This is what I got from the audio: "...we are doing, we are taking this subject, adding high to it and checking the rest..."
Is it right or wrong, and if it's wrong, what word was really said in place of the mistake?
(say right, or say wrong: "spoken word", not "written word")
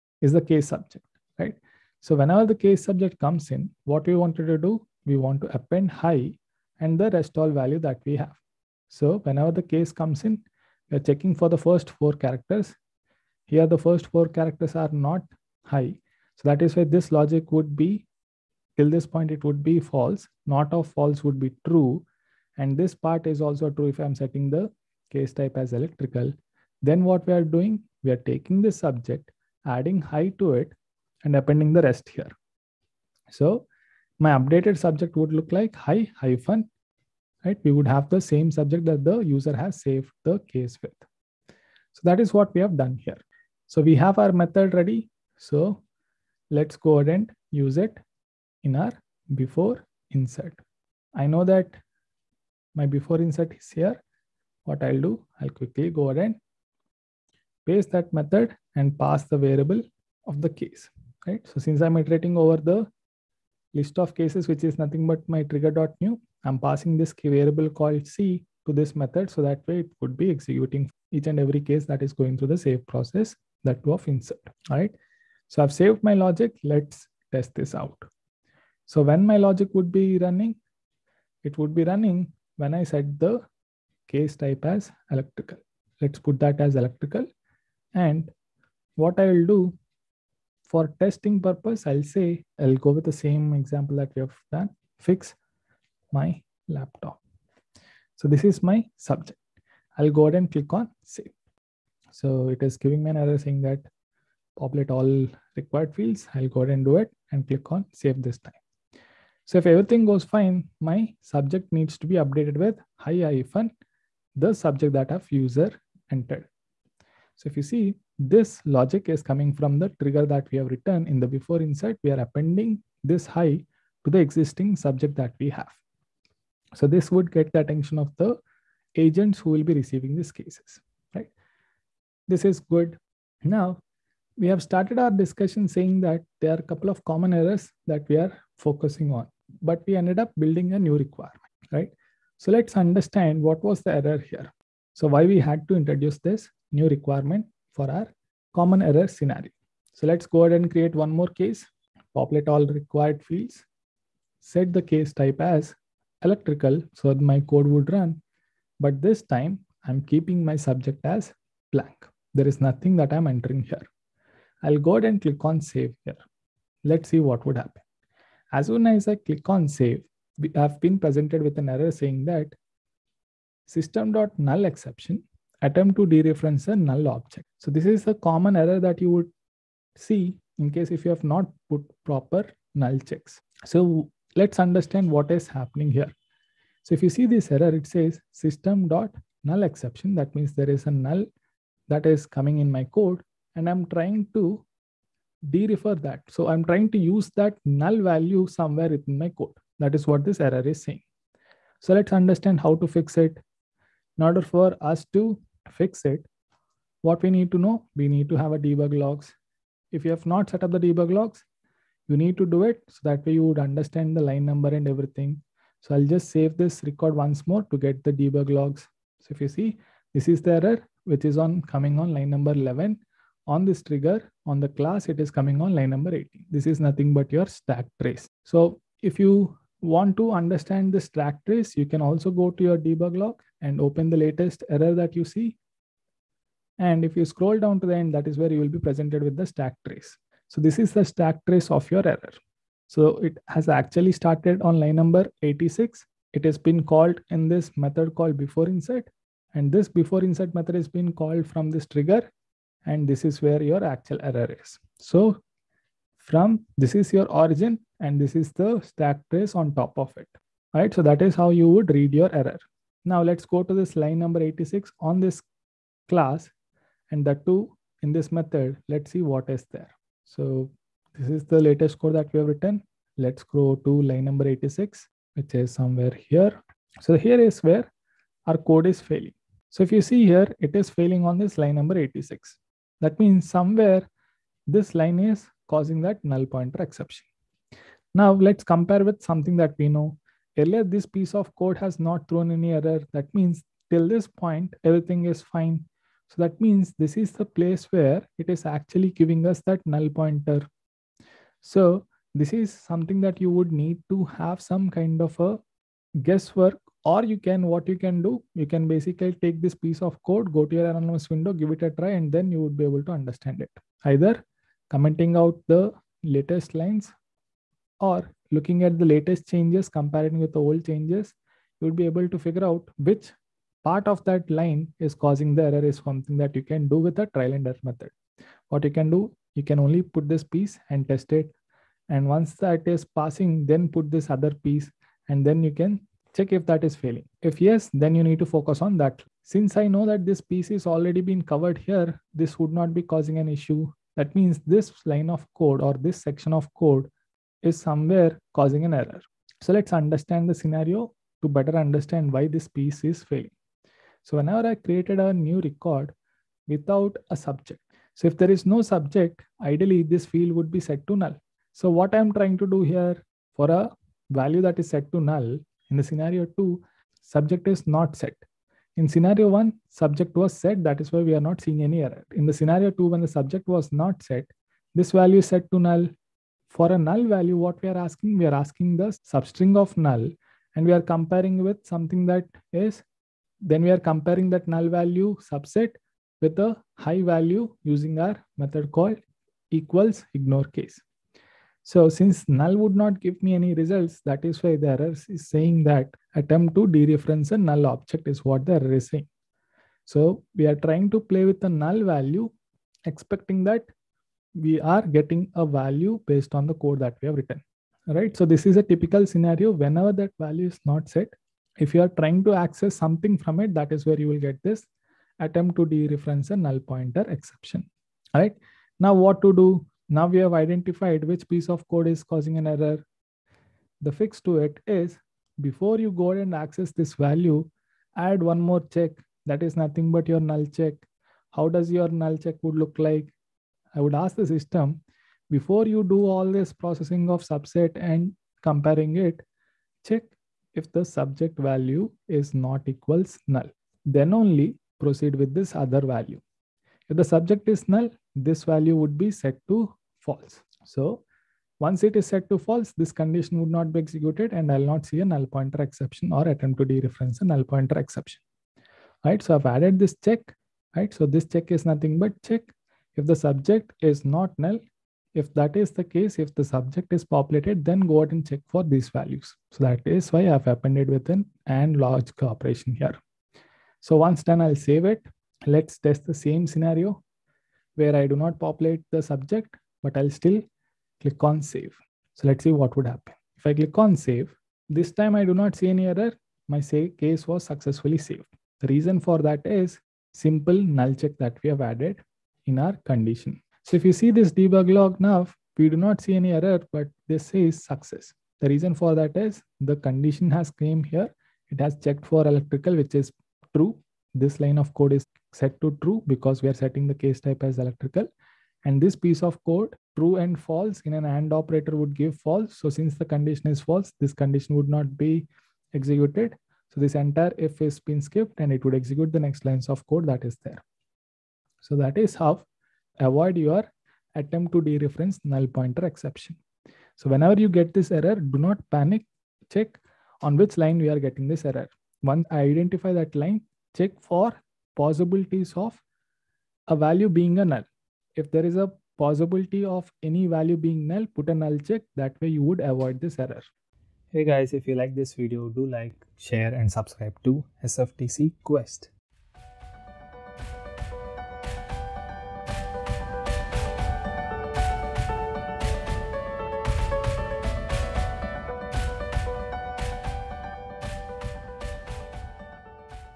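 wrong: "appending", not "checking".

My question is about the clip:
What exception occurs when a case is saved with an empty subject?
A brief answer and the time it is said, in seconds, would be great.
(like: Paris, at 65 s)
system.null exception, at 173 s.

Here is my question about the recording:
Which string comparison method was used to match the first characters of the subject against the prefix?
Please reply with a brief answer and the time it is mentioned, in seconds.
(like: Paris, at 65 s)
equals ignore case, at 389 s.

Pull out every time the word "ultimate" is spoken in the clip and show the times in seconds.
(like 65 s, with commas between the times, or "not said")
not said.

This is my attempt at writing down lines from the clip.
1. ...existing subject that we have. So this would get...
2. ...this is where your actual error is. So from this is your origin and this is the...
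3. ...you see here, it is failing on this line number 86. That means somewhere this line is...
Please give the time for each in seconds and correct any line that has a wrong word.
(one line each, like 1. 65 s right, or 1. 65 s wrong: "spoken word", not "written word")
1. 124 s right
2. 253 s right
3. 279 s right.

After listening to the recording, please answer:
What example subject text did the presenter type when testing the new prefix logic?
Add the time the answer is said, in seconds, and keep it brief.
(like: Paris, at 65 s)
fix my laptop, at 95 s.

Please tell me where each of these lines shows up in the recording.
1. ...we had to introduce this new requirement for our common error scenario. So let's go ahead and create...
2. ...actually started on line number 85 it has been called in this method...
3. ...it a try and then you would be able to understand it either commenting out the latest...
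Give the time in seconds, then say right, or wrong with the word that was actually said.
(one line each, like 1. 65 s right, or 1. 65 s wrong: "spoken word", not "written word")
1. 145 s right
2. 243 s wrong: "86", not "85"
3. 311 s right.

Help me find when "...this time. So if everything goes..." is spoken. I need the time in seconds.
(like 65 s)
108 s.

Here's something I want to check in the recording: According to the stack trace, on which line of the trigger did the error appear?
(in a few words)
11.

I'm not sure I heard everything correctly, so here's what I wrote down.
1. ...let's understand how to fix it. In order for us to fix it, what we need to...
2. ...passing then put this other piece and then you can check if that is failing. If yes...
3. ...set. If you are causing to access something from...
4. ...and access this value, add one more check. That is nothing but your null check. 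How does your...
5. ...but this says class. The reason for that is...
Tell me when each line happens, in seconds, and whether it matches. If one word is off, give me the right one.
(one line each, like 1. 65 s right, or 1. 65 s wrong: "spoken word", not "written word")
1. 201 s right
2. 333 s right
3. 411 s wrong: "trying", not "causing"
4. 426 s right
5. 496 s wrong: "success", not "class".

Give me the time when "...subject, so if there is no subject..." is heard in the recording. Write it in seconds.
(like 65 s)
357 s.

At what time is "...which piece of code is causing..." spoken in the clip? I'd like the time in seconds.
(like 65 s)
421 s.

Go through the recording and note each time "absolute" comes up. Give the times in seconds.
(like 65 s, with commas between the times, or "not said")
not said.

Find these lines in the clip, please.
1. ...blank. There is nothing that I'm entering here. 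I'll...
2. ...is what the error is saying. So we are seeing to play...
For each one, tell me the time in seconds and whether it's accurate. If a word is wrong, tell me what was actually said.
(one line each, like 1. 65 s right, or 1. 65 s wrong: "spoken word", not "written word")
1. 161 s right
2. 398 s wrong: "trying", not "seeing".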